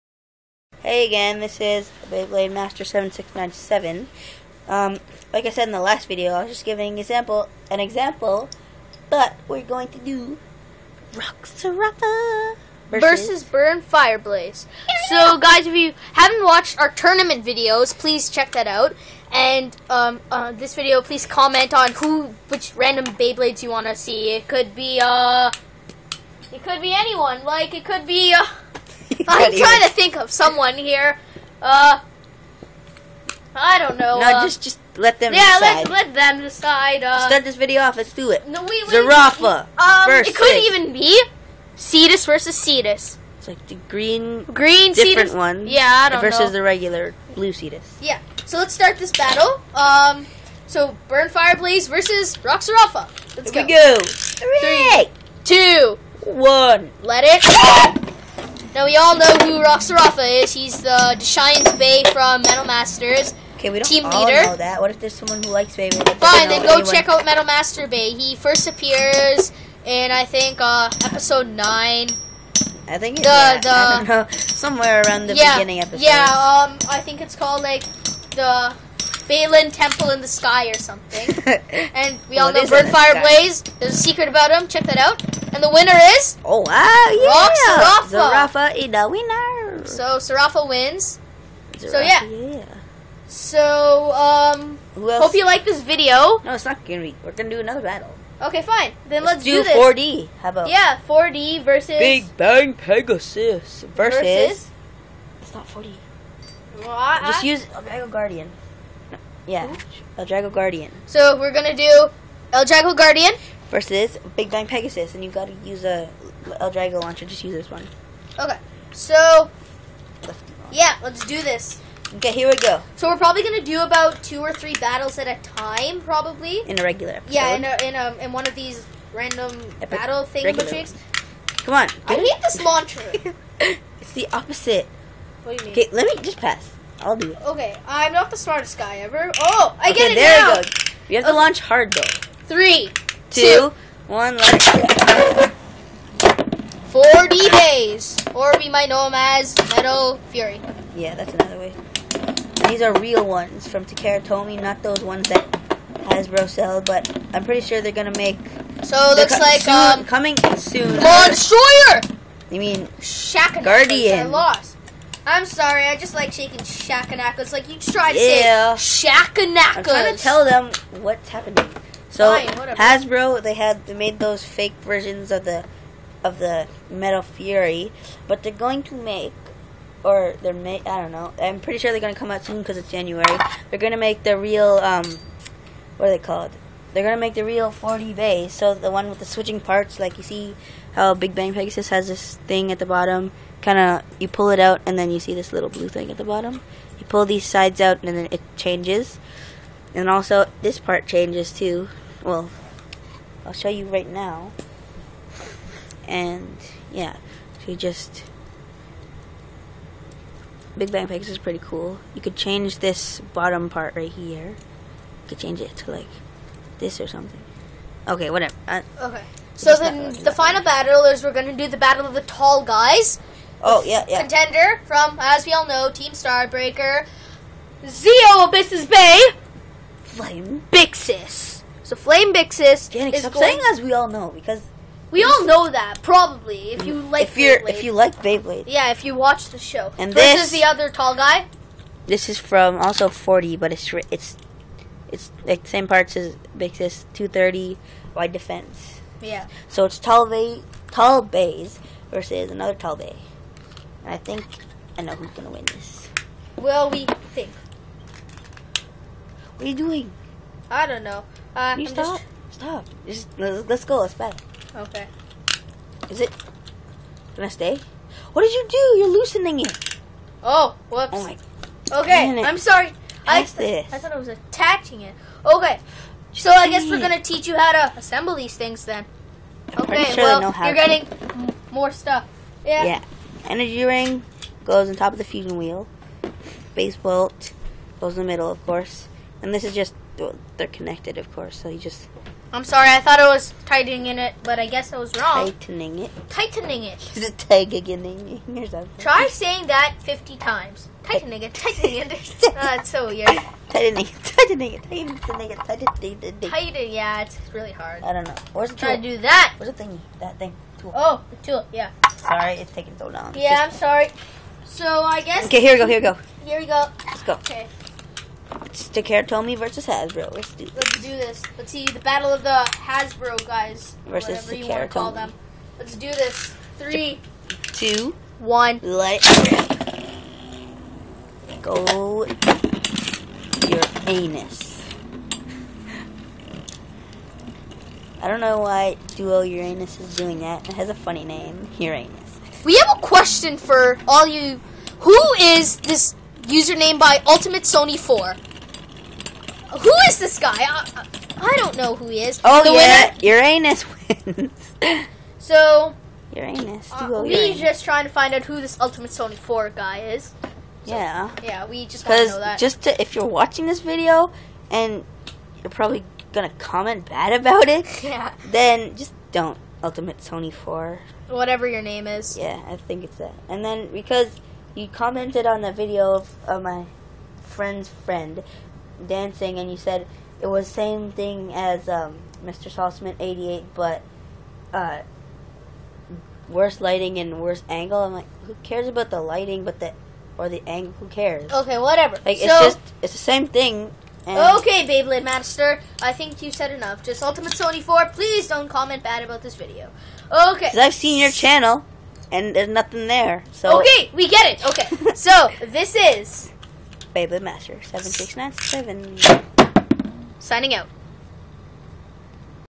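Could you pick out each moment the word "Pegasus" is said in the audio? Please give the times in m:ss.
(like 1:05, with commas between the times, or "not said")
1:42, 1:54, 3:11.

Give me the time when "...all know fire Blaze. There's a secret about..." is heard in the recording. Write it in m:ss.
1:22.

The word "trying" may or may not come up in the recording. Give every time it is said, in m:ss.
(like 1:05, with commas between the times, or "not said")
0:29, 2:49, 5:57.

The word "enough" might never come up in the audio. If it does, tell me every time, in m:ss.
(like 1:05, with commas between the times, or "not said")
6:36.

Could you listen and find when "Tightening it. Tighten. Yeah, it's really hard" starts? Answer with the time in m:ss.
5:05.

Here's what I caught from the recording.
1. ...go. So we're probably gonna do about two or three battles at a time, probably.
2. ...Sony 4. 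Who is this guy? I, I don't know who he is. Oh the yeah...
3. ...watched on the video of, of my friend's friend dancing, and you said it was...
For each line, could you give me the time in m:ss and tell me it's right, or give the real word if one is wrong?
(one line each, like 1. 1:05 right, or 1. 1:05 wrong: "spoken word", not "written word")
1. 2:02 right
2. 5:47 right
3. 6:14 wrong: "commented", not "watched".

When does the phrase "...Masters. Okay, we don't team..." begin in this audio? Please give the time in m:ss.
1:02.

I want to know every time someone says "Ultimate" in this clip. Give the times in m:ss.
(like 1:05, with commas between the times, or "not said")
5:47, 5:58, 6:09, 6:37.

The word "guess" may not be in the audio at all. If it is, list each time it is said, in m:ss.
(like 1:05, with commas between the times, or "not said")
4:36, 4:54, 5:15.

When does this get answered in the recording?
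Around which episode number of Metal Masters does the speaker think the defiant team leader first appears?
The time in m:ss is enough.
1:11.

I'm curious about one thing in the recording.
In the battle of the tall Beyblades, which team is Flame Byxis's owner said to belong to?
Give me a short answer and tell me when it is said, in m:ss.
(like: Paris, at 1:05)
Team Starbreaker, at 3:45.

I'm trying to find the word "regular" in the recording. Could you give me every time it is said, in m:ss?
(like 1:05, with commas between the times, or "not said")
0:46, 2:06.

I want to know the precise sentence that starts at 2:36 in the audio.
But I'm pretty sure they're gonna make.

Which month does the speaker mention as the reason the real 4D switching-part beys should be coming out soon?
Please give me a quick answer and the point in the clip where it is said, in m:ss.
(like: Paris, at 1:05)
January, at 3:02.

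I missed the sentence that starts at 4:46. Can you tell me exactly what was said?
Base bolt goes in the middle, of course.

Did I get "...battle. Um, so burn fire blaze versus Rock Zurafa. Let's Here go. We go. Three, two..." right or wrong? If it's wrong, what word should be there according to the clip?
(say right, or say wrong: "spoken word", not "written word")
right.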